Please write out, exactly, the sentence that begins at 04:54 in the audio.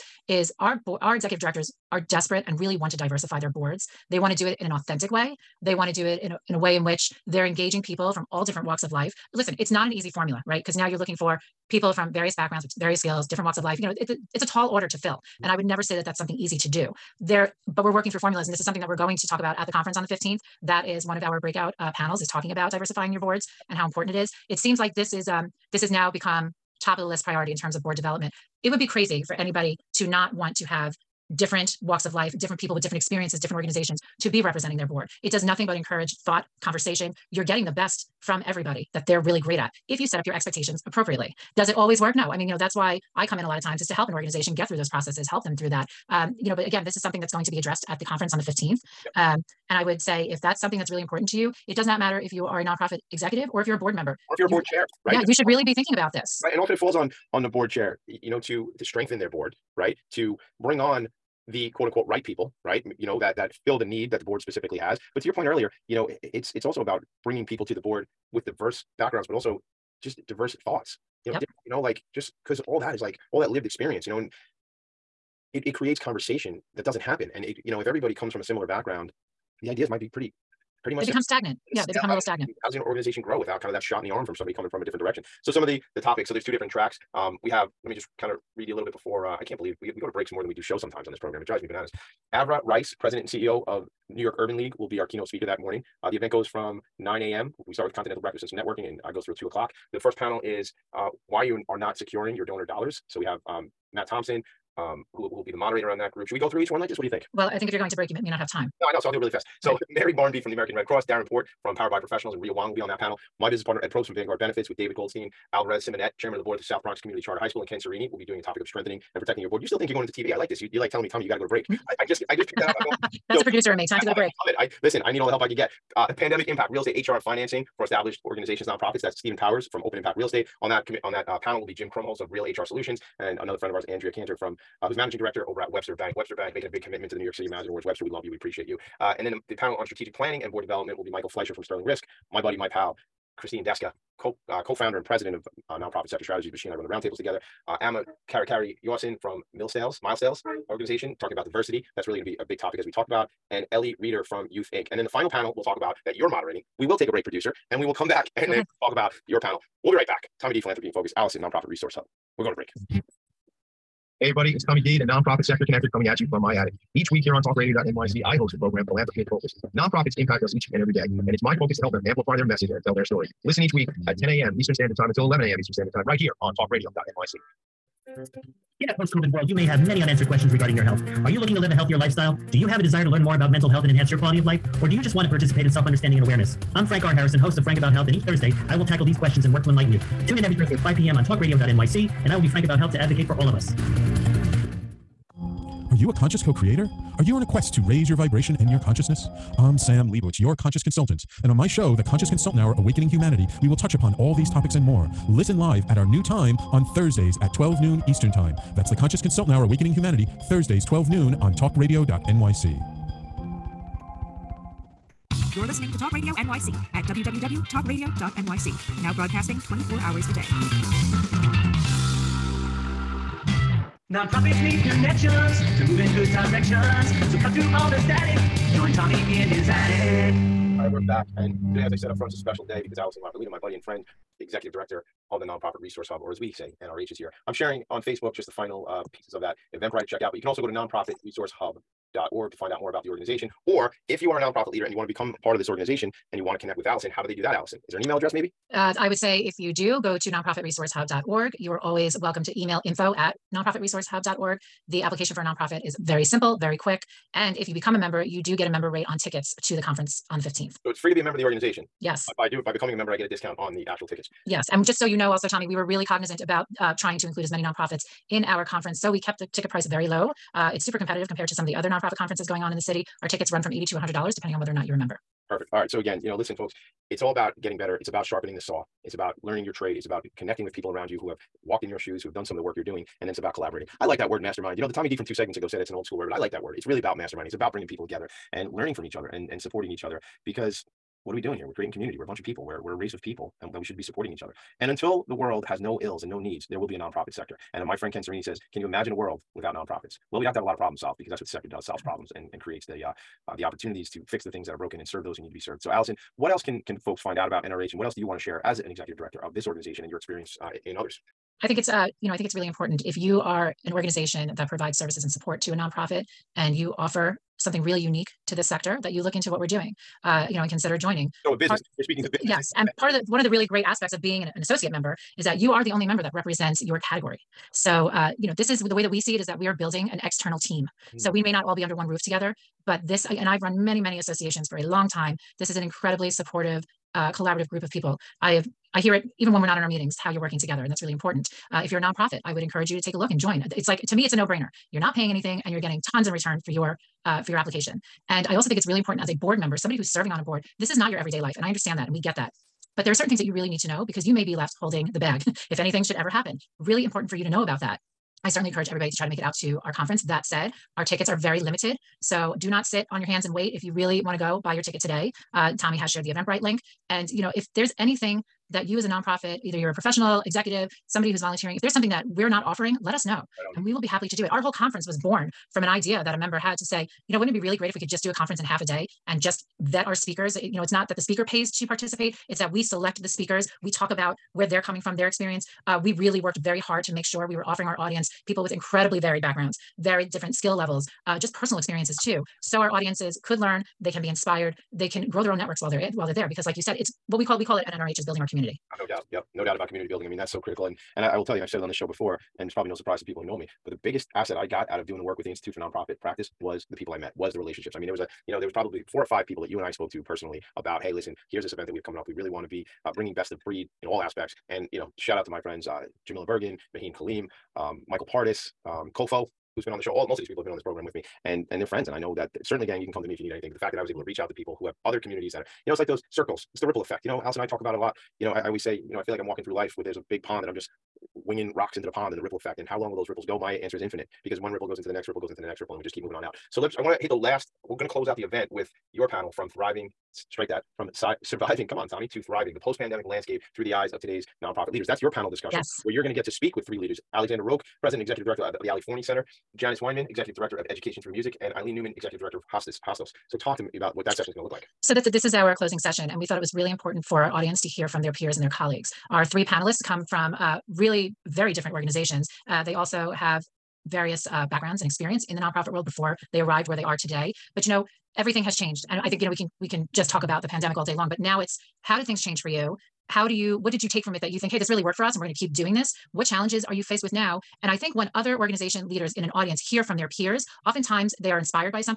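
And until the world has no ills and no needs, there will be a nonprofit sector.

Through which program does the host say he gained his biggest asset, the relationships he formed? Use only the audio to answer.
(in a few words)
Institute for Nonprofit Practice.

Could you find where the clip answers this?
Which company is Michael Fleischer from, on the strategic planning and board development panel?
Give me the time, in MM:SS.
02:21.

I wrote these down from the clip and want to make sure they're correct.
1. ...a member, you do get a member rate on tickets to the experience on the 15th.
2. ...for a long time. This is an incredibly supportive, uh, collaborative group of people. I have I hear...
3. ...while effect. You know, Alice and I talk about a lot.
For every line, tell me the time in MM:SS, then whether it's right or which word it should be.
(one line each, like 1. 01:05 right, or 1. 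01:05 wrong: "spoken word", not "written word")
1. 04:17 wrong: "conference", not "experience"
2. 05:34 right
3. 07:06 wrong: "ripple", not "while".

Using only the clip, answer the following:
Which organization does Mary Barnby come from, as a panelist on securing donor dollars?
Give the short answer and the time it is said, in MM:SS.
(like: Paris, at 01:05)
American Red Cross, at 01:50.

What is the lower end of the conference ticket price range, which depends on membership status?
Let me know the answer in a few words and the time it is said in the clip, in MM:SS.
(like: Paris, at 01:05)
$80, at 04:33.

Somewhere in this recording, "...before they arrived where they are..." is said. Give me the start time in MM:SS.
07:46.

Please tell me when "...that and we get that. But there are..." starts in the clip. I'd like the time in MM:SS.
05:51.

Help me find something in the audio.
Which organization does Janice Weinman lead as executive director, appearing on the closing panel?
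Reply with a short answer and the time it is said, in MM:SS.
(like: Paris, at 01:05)
Education Through Music, at 07:30.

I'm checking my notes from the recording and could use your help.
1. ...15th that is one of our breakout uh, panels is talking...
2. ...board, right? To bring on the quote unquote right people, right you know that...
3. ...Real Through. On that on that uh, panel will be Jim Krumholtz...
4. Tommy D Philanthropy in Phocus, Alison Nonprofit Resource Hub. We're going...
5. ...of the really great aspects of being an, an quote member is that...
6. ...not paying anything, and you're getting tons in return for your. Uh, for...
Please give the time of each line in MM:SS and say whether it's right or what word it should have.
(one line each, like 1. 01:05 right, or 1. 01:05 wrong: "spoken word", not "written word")
1. 00:20 right
2. 00:59 right
3. 02:10 wrong: "Estate", not "Through"
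4. 02:40 right
5. 05:23 wrong: "associate", not "quote"
6. 05:44 right.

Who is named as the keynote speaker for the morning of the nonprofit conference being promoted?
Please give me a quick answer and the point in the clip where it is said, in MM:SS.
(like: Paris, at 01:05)
Arva Rice, at 01:32.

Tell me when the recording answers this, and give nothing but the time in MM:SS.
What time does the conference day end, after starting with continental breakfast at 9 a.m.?
01:39.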